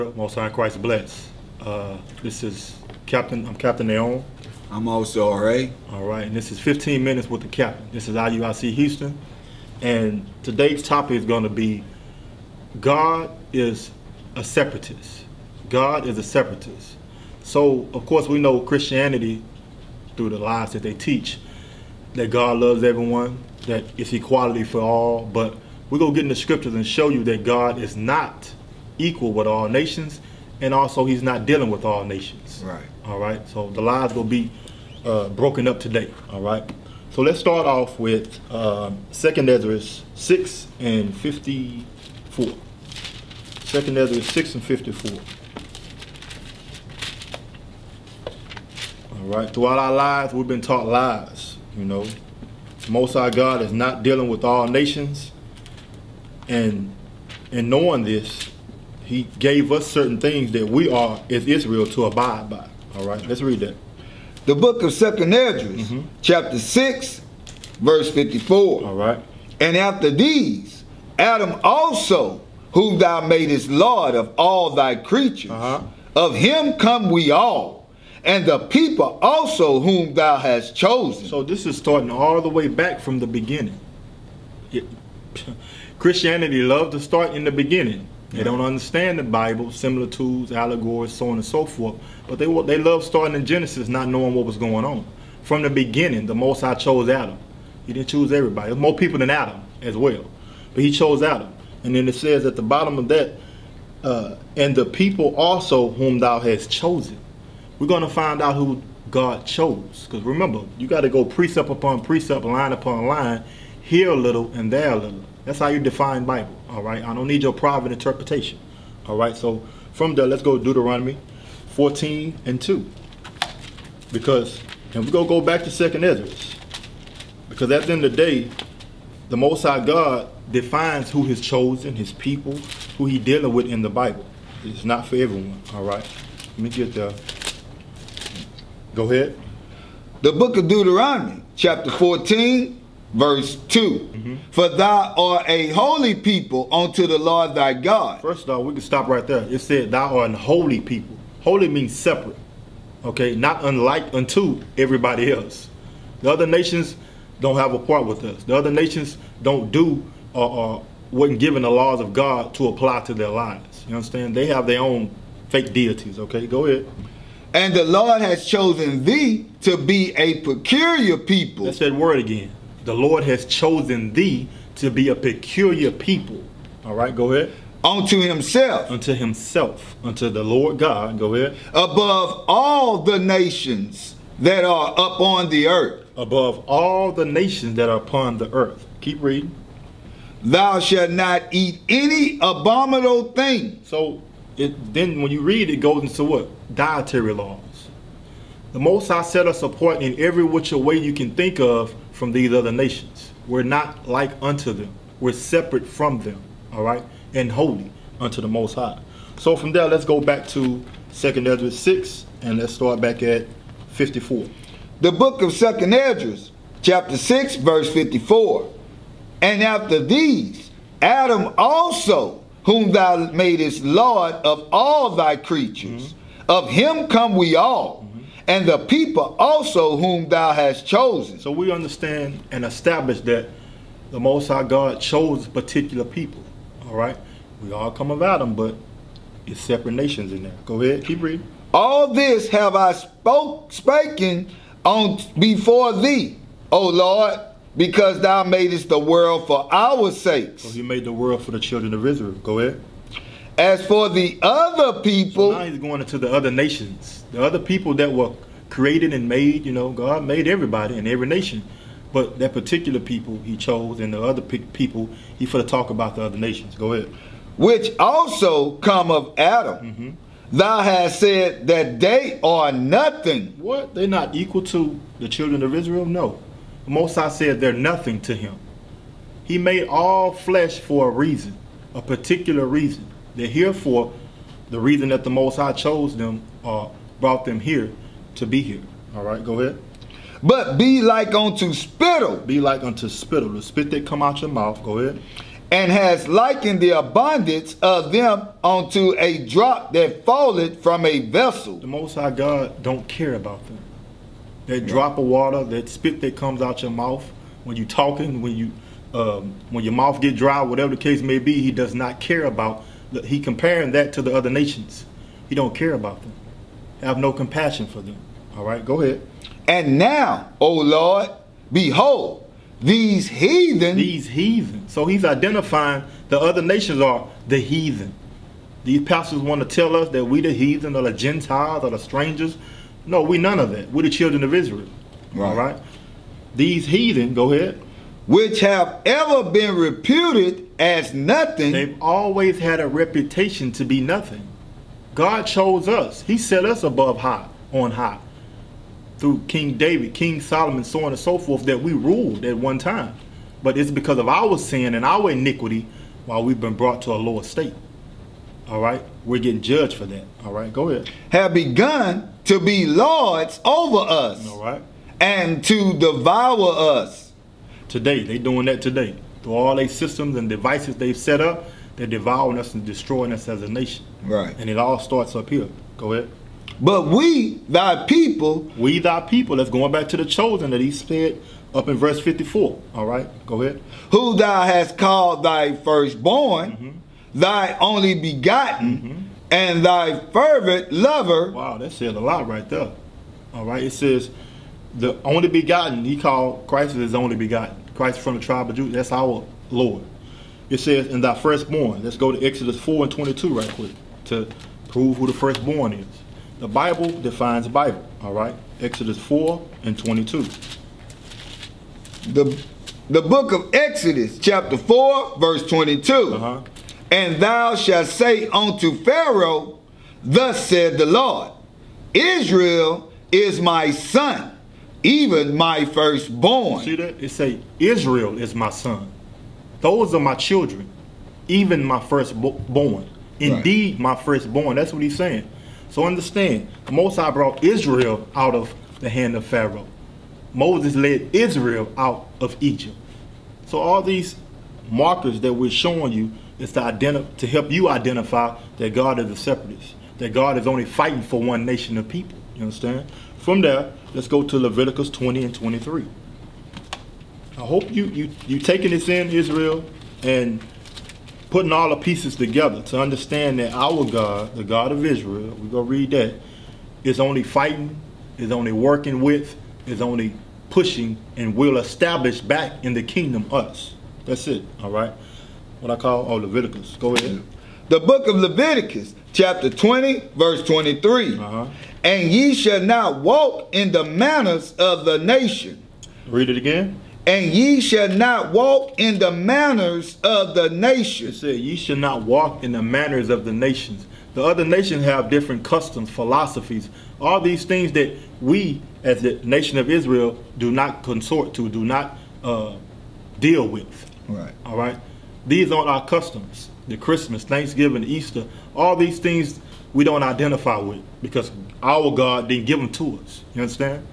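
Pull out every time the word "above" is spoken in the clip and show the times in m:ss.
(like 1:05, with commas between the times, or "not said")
3:01, 3:06, 5:46.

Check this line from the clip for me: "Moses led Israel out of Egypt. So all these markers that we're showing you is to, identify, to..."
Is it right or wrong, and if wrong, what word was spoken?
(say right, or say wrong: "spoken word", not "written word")
right.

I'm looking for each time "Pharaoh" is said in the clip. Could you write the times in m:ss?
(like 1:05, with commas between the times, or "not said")
6:59, 7:19.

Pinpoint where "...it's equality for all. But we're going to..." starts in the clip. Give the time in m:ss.
0:23.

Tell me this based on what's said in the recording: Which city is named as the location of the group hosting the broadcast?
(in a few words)
Houston.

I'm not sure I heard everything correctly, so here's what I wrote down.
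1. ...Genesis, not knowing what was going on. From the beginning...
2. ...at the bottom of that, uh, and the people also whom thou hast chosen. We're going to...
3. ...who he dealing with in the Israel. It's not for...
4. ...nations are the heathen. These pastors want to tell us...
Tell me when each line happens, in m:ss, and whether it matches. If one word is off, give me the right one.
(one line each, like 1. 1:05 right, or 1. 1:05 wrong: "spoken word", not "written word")
1. 1:33 right
2. 1:42 right
3. 2:12 wrong: "Bible", not "Israel"
4. 5:26 right.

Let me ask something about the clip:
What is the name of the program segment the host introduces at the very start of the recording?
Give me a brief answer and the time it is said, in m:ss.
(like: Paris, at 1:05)
15 minutes with the captain, at 0:06.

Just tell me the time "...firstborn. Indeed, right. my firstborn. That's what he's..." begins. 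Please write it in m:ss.
7:11.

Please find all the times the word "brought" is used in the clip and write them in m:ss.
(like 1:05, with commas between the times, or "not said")
4:47, 5:56, 7:17.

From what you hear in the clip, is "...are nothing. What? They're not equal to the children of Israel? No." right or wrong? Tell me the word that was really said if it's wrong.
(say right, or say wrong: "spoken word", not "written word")
right.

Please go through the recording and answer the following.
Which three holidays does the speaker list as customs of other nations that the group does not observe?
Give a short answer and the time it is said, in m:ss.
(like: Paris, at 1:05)
Christmas, Thanksgiving, Easter, at 8:26.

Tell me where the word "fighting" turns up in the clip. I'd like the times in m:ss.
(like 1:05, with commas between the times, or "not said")
7:30, 7:47.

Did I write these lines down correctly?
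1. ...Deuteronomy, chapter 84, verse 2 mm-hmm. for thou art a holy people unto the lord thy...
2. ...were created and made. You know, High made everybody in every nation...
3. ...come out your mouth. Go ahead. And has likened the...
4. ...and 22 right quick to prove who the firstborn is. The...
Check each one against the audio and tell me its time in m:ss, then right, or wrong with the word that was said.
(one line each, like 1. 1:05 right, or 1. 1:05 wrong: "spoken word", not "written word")
1. 2:20 wrong: "14", not "84"
2. 4:18 wrong: "God", not "High"
3. 4:54 right
4. 6:43 right.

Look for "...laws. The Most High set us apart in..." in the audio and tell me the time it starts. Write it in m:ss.
3:17.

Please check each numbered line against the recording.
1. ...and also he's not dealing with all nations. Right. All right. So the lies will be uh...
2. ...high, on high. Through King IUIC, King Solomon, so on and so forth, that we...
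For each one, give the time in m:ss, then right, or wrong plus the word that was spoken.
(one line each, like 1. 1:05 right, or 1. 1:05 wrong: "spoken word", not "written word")
1. 0:30 right
2. 5:47 wrong: "David", not "IUIC".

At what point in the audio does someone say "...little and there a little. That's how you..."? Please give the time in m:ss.
1:54.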